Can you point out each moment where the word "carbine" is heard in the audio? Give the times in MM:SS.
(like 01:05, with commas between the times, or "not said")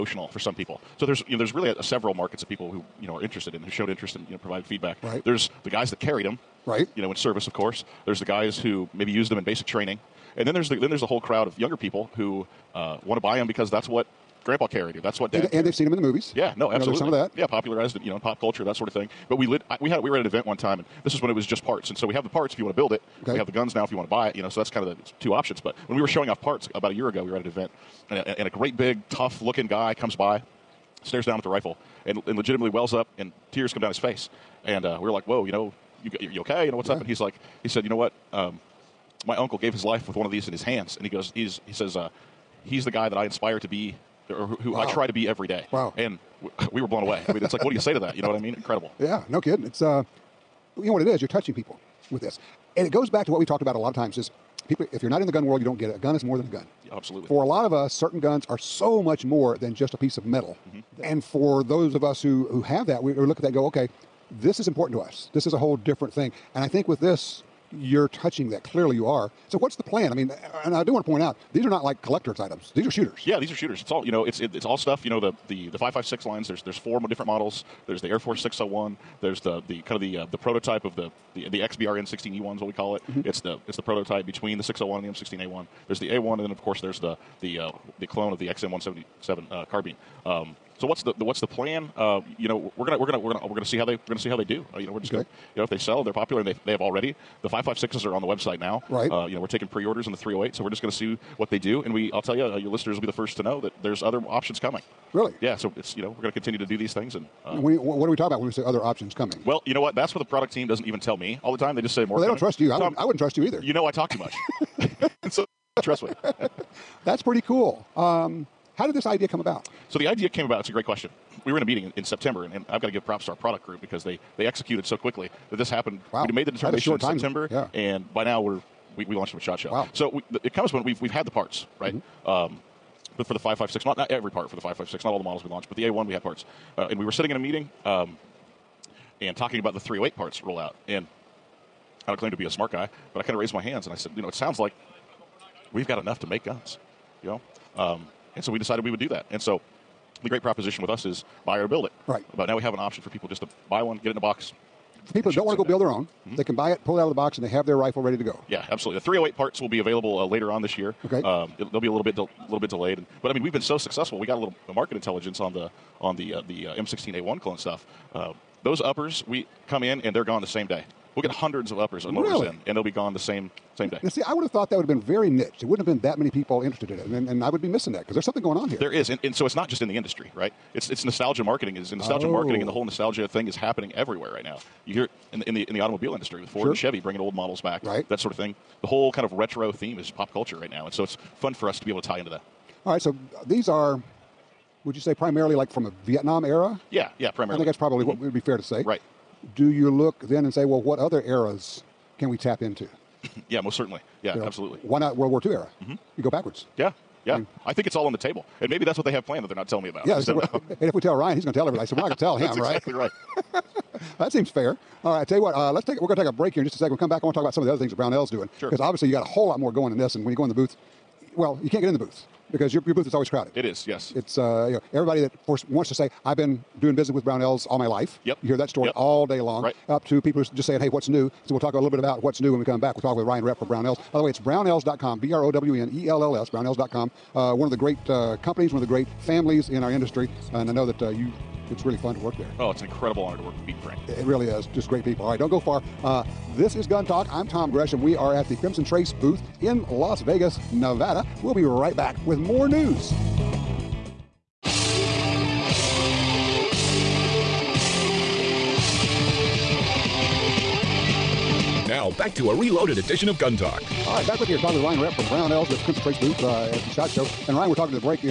01:29.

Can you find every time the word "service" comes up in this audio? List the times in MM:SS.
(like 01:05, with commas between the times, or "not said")
00:07.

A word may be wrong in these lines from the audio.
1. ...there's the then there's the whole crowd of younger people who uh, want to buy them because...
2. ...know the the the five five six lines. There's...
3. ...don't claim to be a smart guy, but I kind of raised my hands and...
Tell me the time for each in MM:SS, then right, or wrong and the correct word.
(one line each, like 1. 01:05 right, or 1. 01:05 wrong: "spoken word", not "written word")
1. 00:10 right
2. 01:15 right
3. 02:22 right.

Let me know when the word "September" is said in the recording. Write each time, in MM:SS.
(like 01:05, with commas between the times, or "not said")
02:02, 02:06.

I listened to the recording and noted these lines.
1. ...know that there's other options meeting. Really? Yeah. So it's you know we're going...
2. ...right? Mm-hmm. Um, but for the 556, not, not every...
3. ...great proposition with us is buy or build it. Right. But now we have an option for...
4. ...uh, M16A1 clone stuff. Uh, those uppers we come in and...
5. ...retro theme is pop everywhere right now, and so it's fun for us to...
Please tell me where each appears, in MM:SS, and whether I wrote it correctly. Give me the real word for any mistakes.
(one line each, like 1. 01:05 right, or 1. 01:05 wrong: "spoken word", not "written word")
1. 01:43 wrong: "coming", not "meeting"
2. 02:11 right
3. 02:30 right
4. 02:46 right
5. 03:09 wrong: "culture", not "everywhere".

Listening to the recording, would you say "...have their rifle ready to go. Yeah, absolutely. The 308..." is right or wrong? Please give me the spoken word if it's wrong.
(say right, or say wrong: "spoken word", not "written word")
right.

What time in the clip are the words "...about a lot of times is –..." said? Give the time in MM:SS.
00:53.